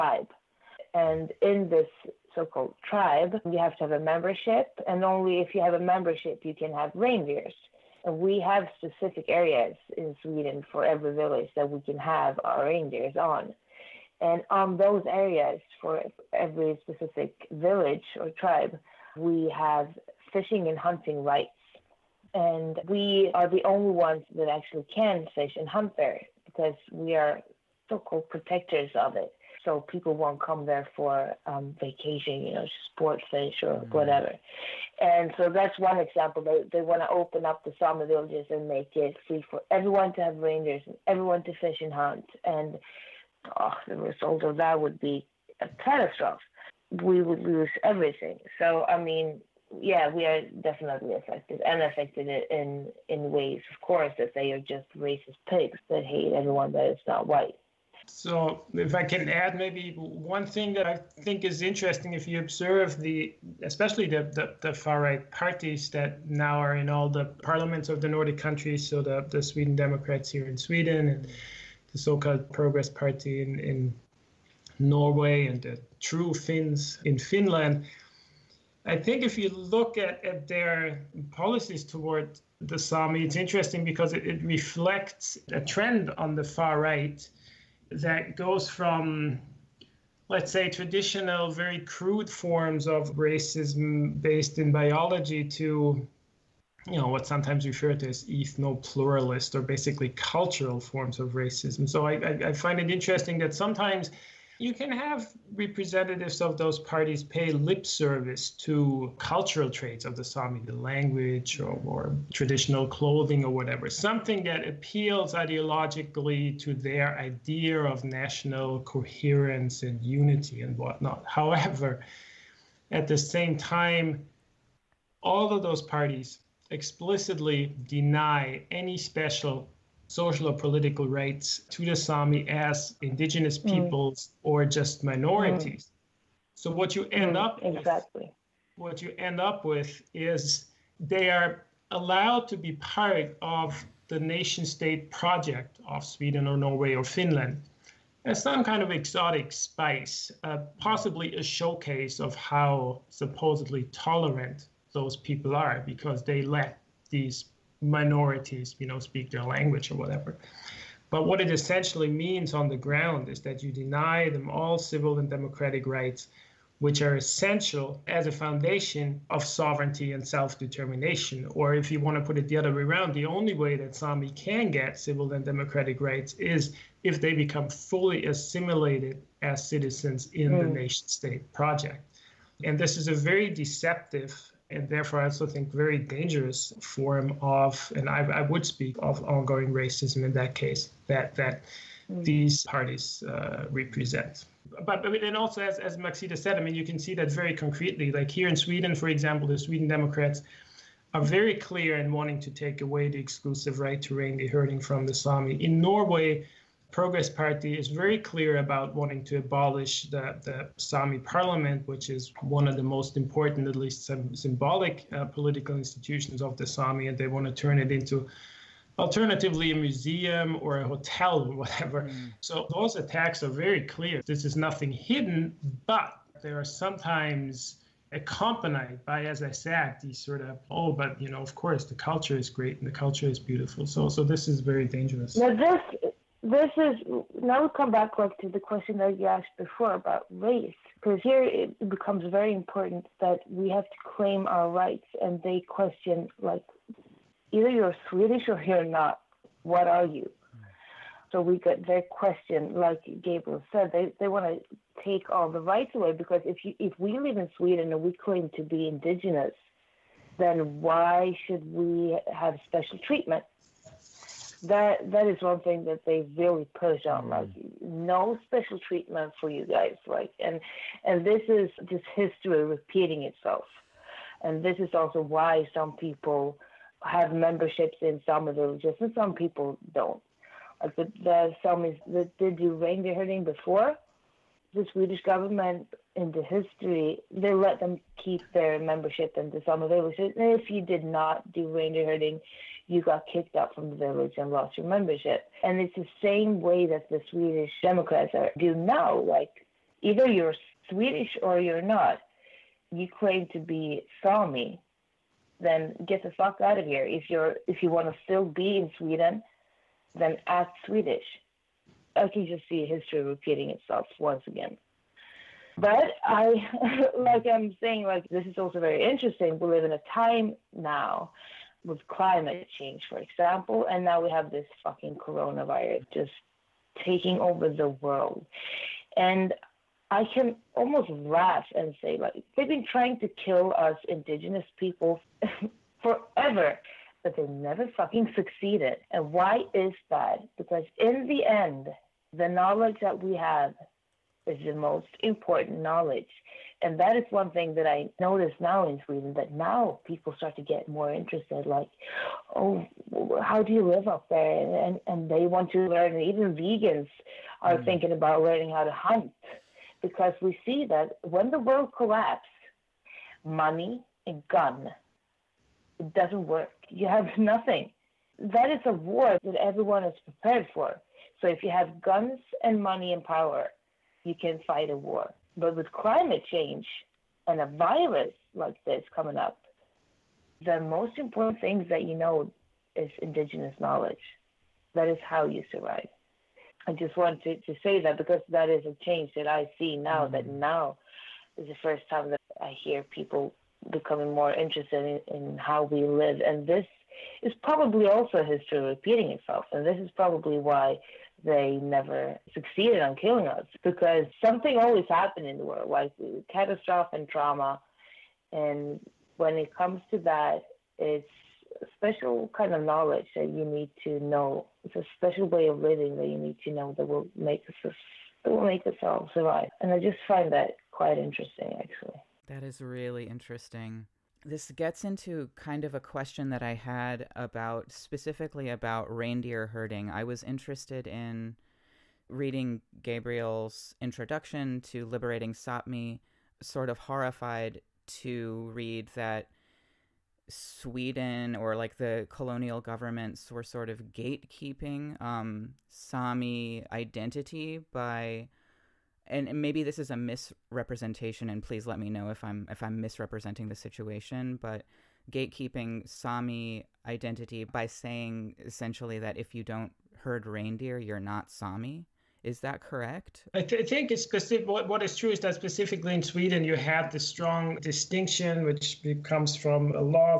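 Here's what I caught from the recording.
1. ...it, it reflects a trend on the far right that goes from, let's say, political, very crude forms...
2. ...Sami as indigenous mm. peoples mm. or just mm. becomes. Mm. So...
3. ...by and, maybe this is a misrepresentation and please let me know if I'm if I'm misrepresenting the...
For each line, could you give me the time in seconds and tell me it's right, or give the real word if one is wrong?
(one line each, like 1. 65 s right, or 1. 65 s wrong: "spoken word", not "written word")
1. 84 s wrong: "traditional", not "political"
2. 131 s wrong: "minorities", not "becomes"
3. 447 s right.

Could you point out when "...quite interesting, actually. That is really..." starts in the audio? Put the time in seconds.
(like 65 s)
420 s.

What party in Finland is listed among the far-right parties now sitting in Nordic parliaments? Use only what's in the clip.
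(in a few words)
True Finns.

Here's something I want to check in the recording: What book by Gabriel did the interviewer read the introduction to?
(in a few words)
Liberating Sápmi.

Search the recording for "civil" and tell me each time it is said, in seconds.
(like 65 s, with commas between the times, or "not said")
164 s, 174 s.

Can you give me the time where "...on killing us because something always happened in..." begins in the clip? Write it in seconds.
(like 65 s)
403 s.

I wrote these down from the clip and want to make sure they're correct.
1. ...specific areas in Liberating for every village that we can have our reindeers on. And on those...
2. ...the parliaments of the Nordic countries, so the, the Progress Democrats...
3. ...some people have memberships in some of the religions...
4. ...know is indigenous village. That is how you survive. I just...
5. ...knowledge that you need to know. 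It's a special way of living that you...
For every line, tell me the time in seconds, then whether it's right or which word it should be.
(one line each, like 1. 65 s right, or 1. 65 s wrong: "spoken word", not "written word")
1. 8 s wrong: "Sweden", not "Liberating"
2. 67 s wrong: "Sweden", not "Progress"
3. 275 s right
4. 382 s wrong: "knowledge", not "village"
5. 412 s right.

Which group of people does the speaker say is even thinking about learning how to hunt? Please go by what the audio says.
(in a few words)
vegans.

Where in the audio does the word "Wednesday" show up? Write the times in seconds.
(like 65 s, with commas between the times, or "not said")
not said.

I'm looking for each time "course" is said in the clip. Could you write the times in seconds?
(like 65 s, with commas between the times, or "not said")
53 s, 231 s.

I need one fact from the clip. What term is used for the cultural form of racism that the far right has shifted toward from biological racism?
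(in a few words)
ethno-pluralist.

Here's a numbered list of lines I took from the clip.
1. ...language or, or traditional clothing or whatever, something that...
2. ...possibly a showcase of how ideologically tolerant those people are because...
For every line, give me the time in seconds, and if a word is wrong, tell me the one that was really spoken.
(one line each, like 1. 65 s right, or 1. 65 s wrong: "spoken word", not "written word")
1. 110 s right
2. 150 s wrong: "supposedly", not "ideologically".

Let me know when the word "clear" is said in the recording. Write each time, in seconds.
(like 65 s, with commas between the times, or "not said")
201 s, 208 s, 223 s.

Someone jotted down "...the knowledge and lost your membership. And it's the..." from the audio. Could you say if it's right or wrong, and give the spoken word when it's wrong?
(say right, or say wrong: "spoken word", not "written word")
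wrong: "village", not "knowledge".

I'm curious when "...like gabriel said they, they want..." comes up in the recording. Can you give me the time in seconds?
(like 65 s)
252 s.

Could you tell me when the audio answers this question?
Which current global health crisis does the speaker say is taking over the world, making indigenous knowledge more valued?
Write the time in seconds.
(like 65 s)
325 s.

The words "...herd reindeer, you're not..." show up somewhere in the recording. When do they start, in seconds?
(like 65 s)
460 s.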